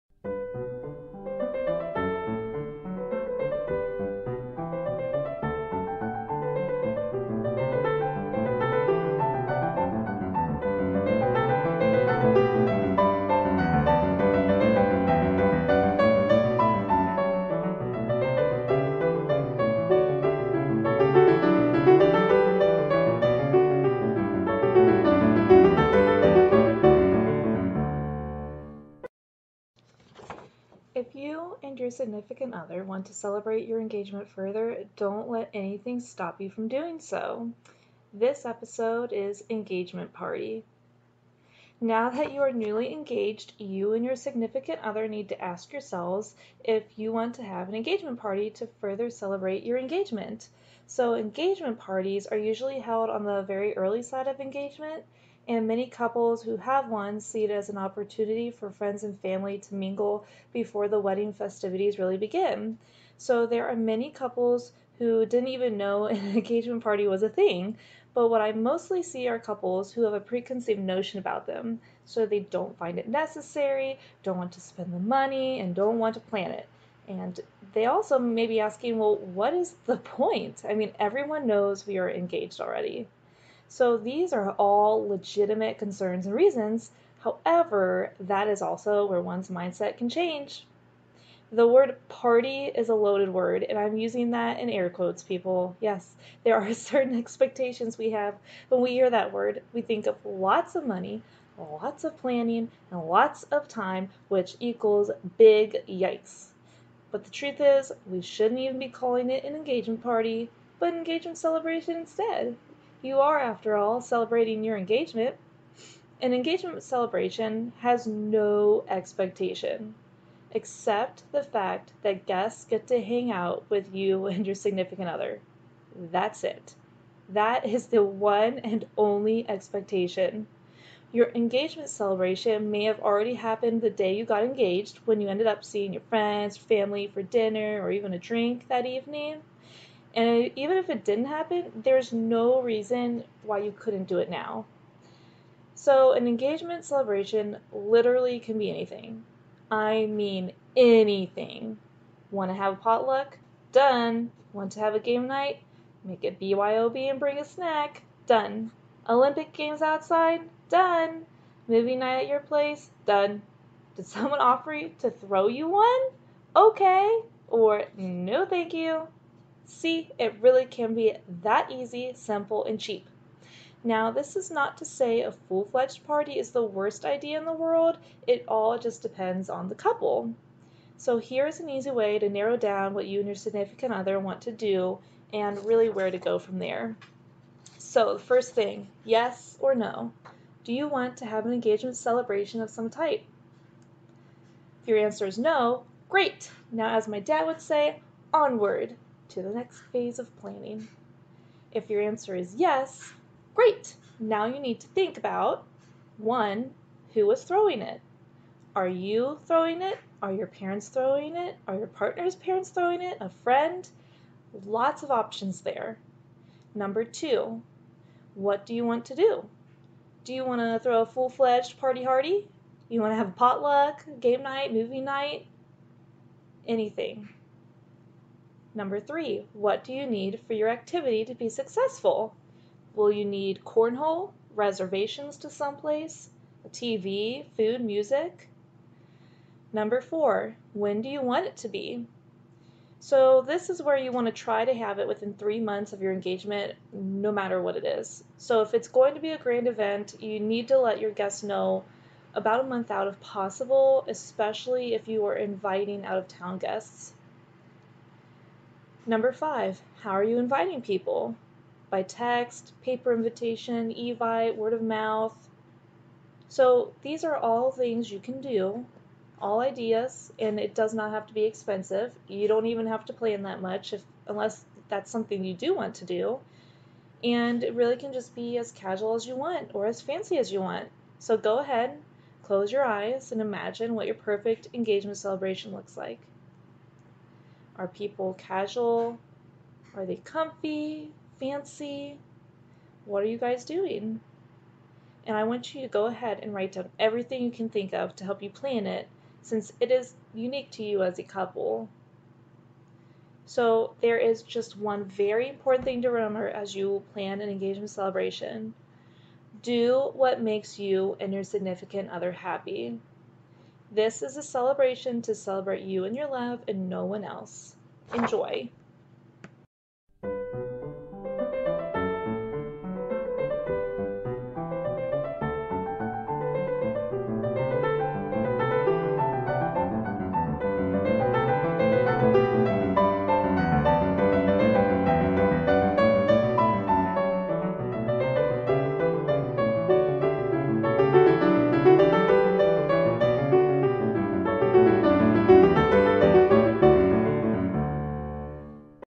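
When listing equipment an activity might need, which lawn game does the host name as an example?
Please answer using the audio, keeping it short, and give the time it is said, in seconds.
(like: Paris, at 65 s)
cornhole, at 233 s.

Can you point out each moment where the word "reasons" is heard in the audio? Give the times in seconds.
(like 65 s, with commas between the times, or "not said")
86 s, 142 s.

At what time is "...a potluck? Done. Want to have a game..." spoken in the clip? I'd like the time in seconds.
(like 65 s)
152 s.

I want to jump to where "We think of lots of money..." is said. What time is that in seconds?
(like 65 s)
99 s.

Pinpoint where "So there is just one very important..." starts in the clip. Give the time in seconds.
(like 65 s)
303 s.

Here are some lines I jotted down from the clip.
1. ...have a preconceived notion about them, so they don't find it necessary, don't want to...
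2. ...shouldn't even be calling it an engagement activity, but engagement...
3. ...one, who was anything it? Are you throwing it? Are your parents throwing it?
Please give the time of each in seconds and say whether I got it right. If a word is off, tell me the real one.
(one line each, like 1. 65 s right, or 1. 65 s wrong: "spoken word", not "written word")
1. 70 s right
2. 108 s wrong: "party", not "activity"
3. 206 s wrong: "throwing", not "anything".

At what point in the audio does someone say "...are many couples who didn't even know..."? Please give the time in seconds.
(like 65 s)
63 s.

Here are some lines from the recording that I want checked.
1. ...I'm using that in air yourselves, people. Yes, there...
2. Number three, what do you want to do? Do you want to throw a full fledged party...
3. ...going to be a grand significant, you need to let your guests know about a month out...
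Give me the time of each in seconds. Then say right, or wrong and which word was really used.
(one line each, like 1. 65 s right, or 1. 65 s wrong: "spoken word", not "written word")
1. 93 s wrong: "quotes", not "yourselves"
2. 216 s wrong: "two", not "three"
3. 248 s wrong: "event", not "significant".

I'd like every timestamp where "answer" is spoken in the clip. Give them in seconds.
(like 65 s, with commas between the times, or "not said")
194 s, 202 s.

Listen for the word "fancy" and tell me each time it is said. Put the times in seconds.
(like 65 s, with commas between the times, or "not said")
280 s, 291 s.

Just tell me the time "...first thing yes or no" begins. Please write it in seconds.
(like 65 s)
188 s.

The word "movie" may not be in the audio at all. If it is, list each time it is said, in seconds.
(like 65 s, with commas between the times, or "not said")
161 s, 224 s.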